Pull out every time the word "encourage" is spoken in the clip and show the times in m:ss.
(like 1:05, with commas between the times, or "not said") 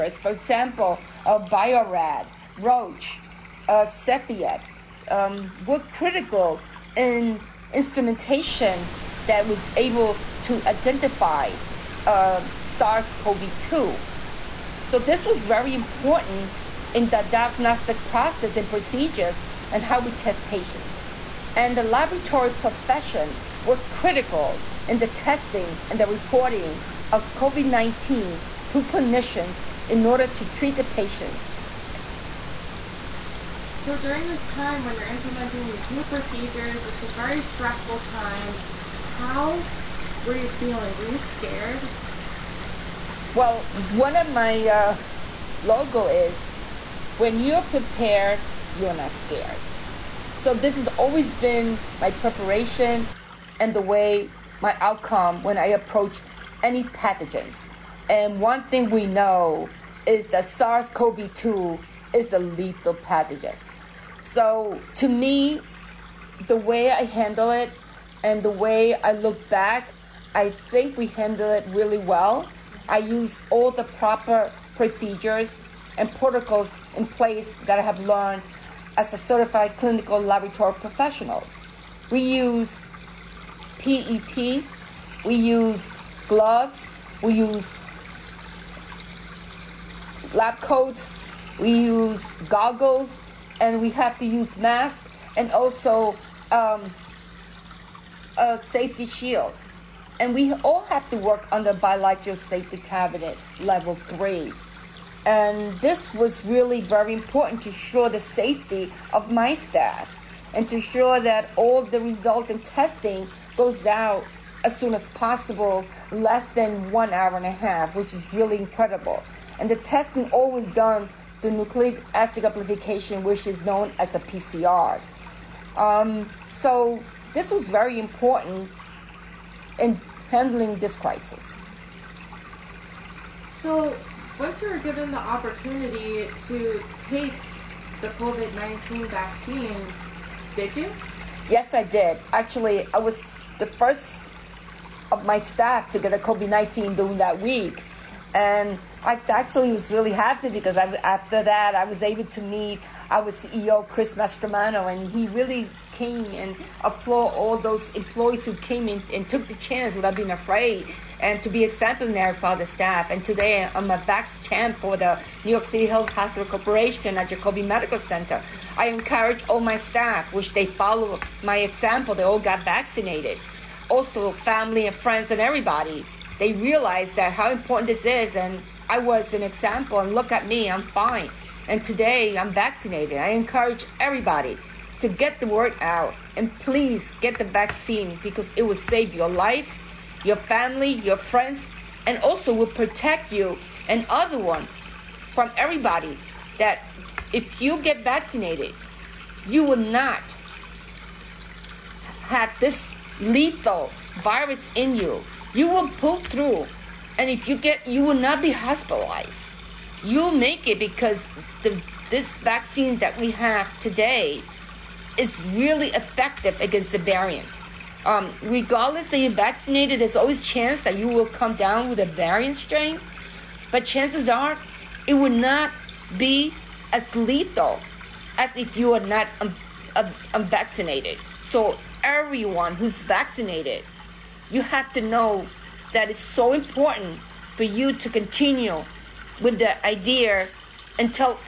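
2:48, 3:03.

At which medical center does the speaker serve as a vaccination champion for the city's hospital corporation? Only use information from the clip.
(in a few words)
Jacobi Medical Center.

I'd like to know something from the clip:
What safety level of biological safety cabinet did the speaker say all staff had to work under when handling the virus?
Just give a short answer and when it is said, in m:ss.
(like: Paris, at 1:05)
Level three, at 1:43.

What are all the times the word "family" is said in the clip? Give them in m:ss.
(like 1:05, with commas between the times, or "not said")
2:54, 3:10.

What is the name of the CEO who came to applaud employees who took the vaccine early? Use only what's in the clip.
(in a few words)
Chris Mastromano.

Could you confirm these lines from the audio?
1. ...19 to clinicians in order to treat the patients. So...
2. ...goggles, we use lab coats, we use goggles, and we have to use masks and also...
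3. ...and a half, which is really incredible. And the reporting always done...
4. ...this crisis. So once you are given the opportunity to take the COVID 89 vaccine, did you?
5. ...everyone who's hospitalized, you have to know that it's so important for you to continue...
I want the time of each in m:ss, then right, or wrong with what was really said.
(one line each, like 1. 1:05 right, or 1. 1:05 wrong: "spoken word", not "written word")
1. 0:27 right
2. 1:26 wrong: "gloves", not "goggles"
3. 1:57 wrong: "testing", not "reporting"
4. 2:10 wrong: "19", not "89"
5. 3:52 wrong: "vaccinated", not "hospitalized".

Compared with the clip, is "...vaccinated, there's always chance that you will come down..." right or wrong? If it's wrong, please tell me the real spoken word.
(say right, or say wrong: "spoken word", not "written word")
right.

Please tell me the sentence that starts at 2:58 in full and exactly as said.
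And I was an example, and look at me, I'm fine.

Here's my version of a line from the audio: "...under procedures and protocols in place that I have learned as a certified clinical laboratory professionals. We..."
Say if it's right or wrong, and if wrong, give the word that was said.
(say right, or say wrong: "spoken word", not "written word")
wrong: "proper", not "under".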